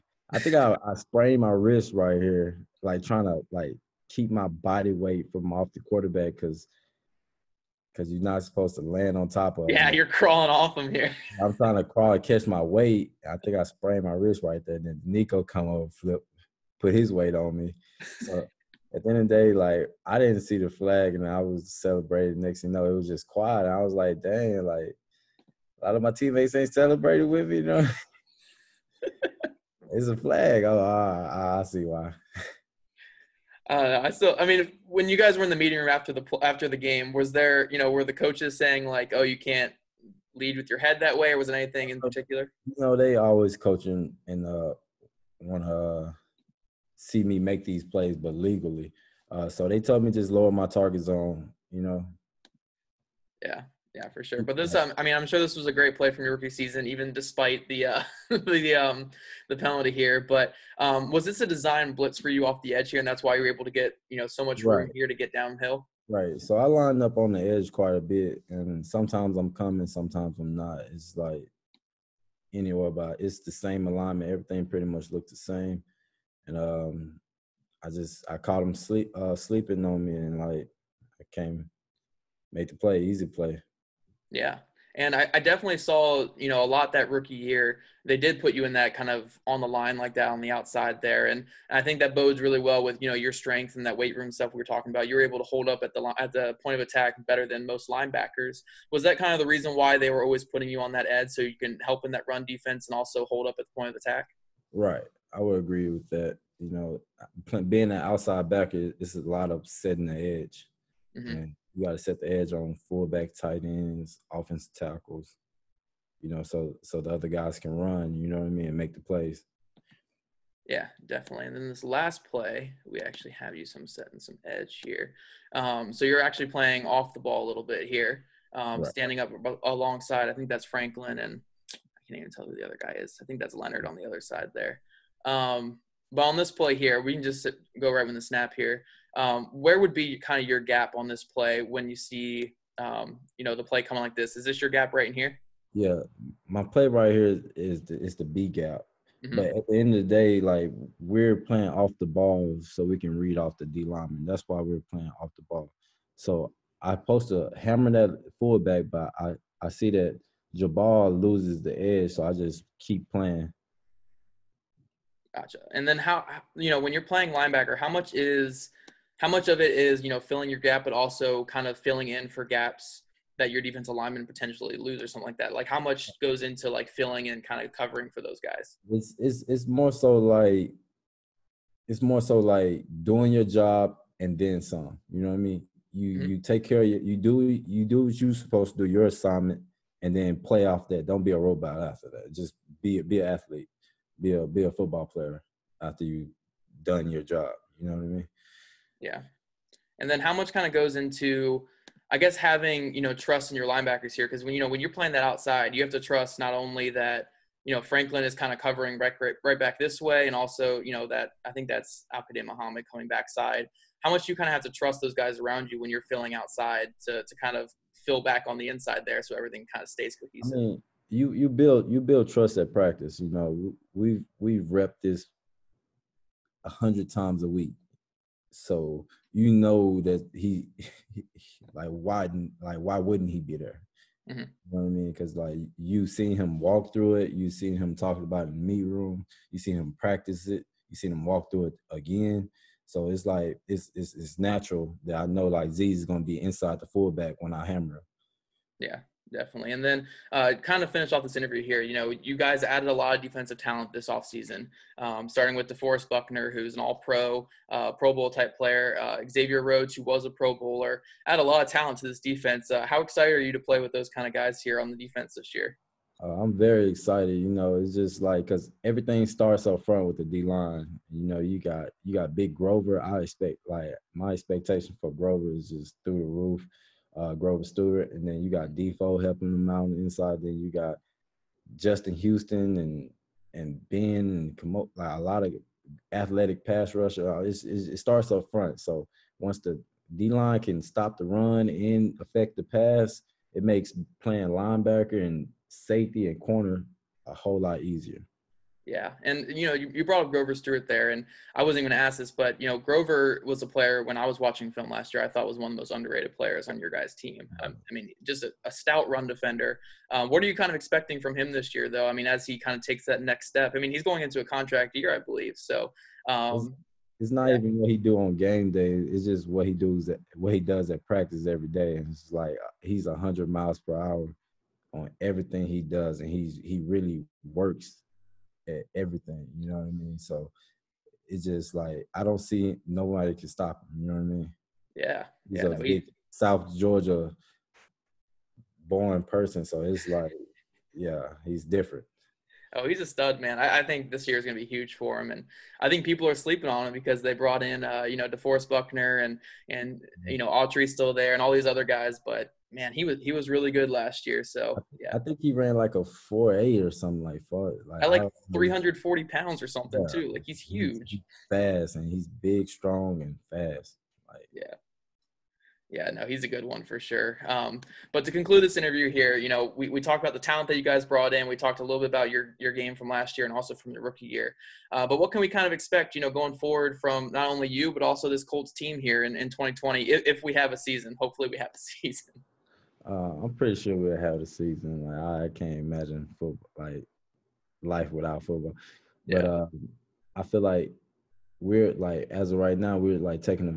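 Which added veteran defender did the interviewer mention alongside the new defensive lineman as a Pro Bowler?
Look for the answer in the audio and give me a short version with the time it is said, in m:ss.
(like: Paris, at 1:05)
Xavier Rhodes, at 4:19.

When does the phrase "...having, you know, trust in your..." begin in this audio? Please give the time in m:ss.
3:22.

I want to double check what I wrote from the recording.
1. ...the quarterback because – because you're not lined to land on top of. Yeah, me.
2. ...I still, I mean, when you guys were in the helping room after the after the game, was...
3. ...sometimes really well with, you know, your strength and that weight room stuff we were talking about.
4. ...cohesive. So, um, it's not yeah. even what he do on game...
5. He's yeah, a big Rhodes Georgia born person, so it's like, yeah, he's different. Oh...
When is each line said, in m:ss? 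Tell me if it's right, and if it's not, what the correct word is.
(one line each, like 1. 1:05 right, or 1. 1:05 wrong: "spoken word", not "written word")
1. 0:05 wrong: "supposed", not "lined"
2. 0:34 wrong: "meeting", not "helping"
3. 1:32 wrong: "bodes", not "sometimes"
4. 5:15 wrong: "believe", not "cohesive"
5. 5:35 wrong: "South", not "Rhodes".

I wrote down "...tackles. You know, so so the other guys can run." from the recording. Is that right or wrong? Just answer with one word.
right.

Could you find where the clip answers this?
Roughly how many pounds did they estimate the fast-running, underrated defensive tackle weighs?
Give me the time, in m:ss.
5:58.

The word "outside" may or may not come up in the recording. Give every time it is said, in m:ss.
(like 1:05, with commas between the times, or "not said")
1:30, 1:48, 3:25, 3:36.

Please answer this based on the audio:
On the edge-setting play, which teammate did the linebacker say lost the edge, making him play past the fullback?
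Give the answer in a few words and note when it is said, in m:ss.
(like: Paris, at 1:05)
Jabaal, at 2:40.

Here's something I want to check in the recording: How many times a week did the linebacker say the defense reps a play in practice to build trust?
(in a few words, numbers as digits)
100.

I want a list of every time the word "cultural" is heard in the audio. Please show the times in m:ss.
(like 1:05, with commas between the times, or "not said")
not said.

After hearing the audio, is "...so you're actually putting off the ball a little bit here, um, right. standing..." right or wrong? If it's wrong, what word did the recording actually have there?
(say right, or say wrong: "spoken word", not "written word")
wrong: "playing", not "putting".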